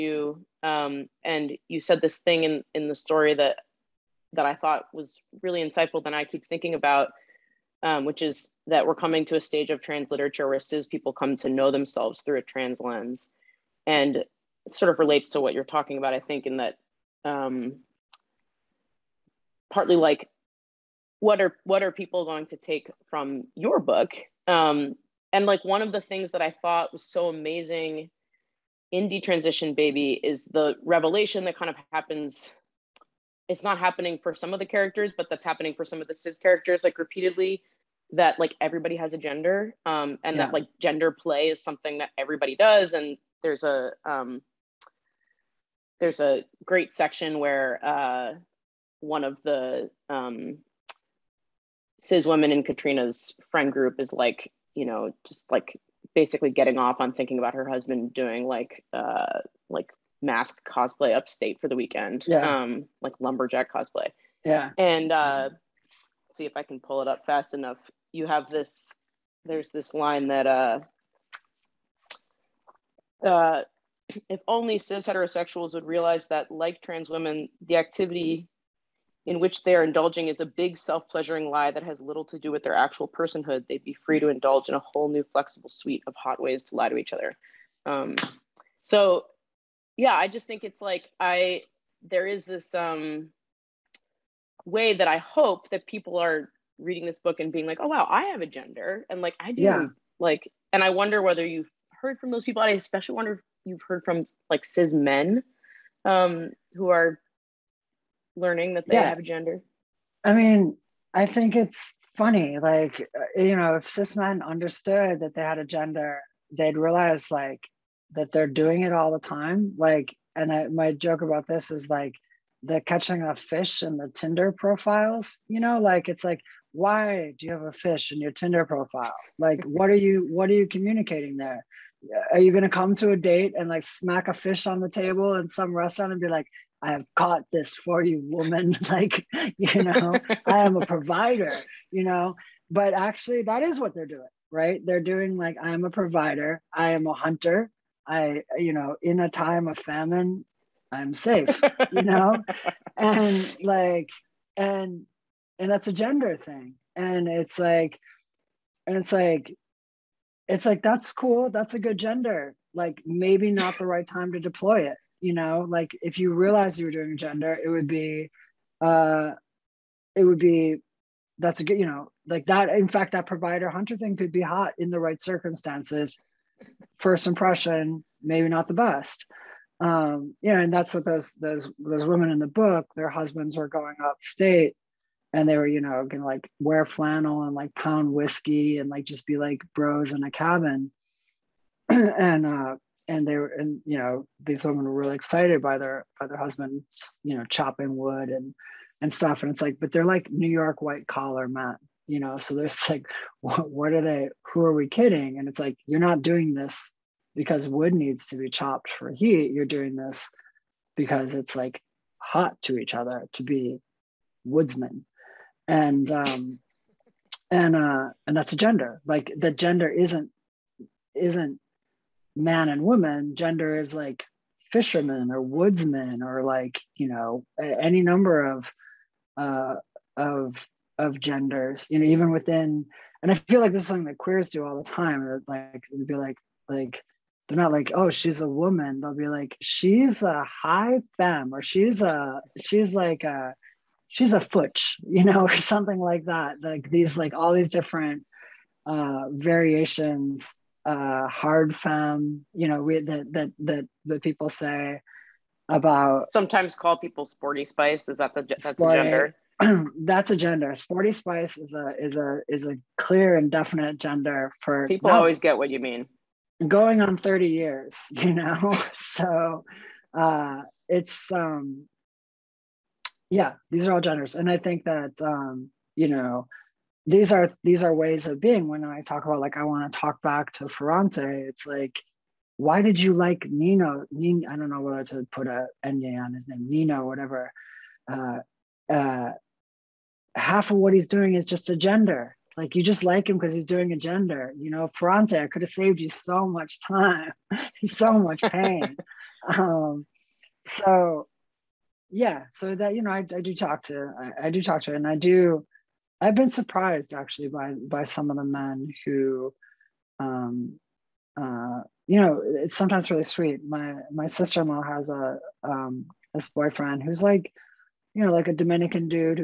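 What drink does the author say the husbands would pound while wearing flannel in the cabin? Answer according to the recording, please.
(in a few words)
whiskey.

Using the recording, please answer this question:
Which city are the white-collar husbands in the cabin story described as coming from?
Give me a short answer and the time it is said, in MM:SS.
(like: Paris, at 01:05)
New York, at 03:20.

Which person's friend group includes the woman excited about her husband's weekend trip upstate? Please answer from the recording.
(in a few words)
Katrina's.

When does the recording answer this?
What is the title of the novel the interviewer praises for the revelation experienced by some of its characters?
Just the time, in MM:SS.
00:29.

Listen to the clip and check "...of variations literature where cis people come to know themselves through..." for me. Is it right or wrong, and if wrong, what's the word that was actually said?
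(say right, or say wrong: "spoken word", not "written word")
wrong: "trans", not "variations".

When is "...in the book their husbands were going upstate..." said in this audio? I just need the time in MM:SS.
03:02.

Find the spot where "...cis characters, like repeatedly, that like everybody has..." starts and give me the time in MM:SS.
00:36.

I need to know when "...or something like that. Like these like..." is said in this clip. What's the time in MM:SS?
04:05.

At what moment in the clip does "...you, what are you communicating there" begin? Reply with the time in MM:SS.
02:09.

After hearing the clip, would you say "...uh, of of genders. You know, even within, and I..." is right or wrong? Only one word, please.
right.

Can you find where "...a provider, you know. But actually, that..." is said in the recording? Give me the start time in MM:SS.
02:20.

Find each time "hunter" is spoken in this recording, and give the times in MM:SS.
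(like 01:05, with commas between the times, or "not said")
02:27, 02:53.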